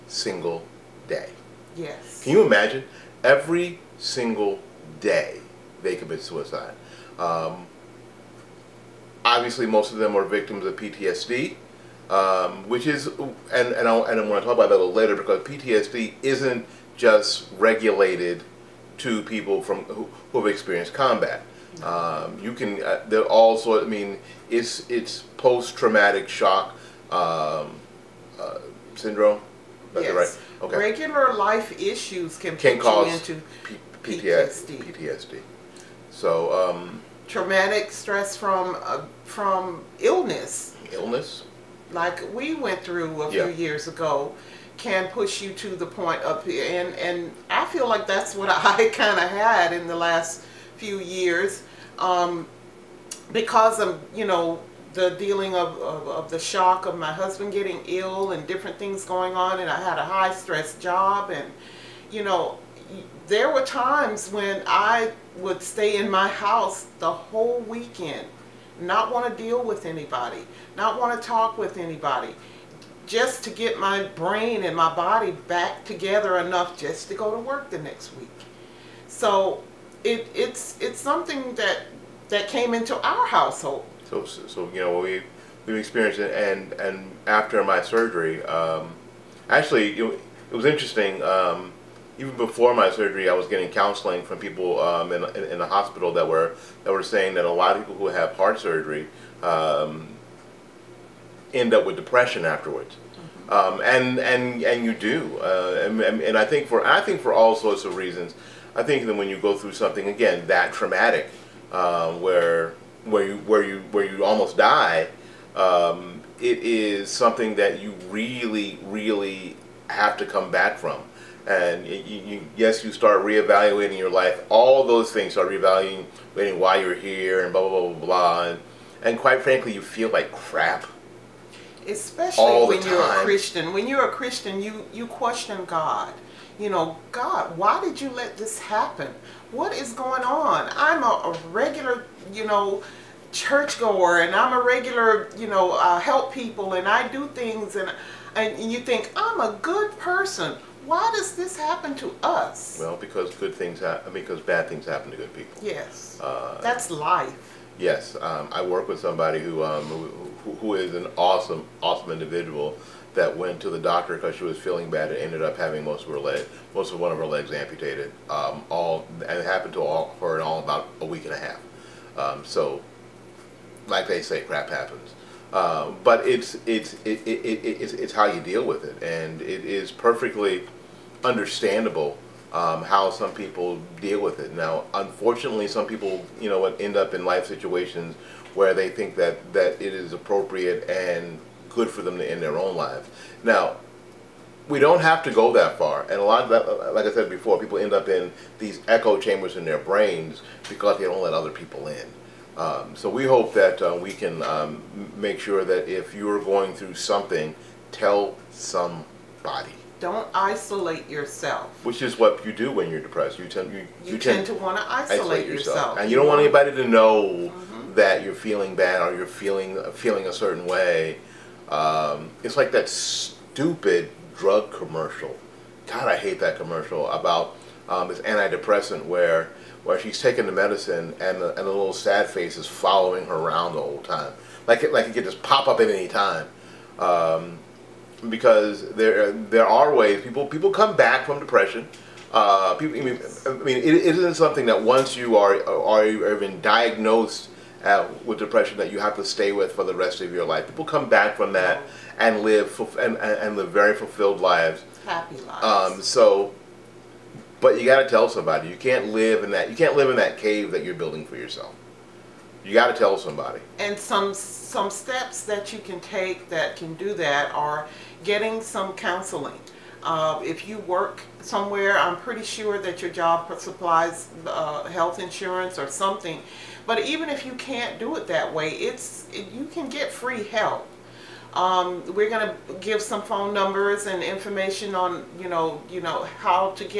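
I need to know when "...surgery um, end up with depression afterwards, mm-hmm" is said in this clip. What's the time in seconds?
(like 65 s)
98 s.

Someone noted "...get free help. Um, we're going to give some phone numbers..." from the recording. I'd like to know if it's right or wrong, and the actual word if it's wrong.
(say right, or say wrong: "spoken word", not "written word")
right.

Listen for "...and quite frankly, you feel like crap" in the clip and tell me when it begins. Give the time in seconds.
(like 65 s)
129 s.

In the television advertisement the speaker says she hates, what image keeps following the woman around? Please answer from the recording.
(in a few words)
little sad face.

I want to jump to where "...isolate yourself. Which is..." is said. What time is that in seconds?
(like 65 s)
210 s.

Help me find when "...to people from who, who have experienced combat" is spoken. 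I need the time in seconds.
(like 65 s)
18 s.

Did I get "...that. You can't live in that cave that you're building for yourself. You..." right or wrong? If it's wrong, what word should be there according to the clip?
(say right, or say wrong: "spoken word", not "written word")
right.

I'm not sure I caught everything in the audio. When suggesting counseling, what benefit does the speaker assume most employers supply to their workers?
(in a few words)
health insurance.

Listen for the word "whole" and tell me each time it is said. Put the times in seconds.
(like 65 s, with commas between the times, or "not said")
67 s, 233 s.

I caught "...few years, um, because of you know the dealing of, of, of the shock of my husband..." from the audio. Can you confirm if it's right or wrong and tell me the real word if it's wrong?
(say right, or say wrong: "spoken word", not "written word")
right.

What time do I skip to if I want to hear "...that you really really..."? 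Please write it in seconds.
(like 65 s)
117 s.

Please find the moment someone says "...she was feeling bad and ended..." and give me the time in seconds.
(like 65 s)
164 s.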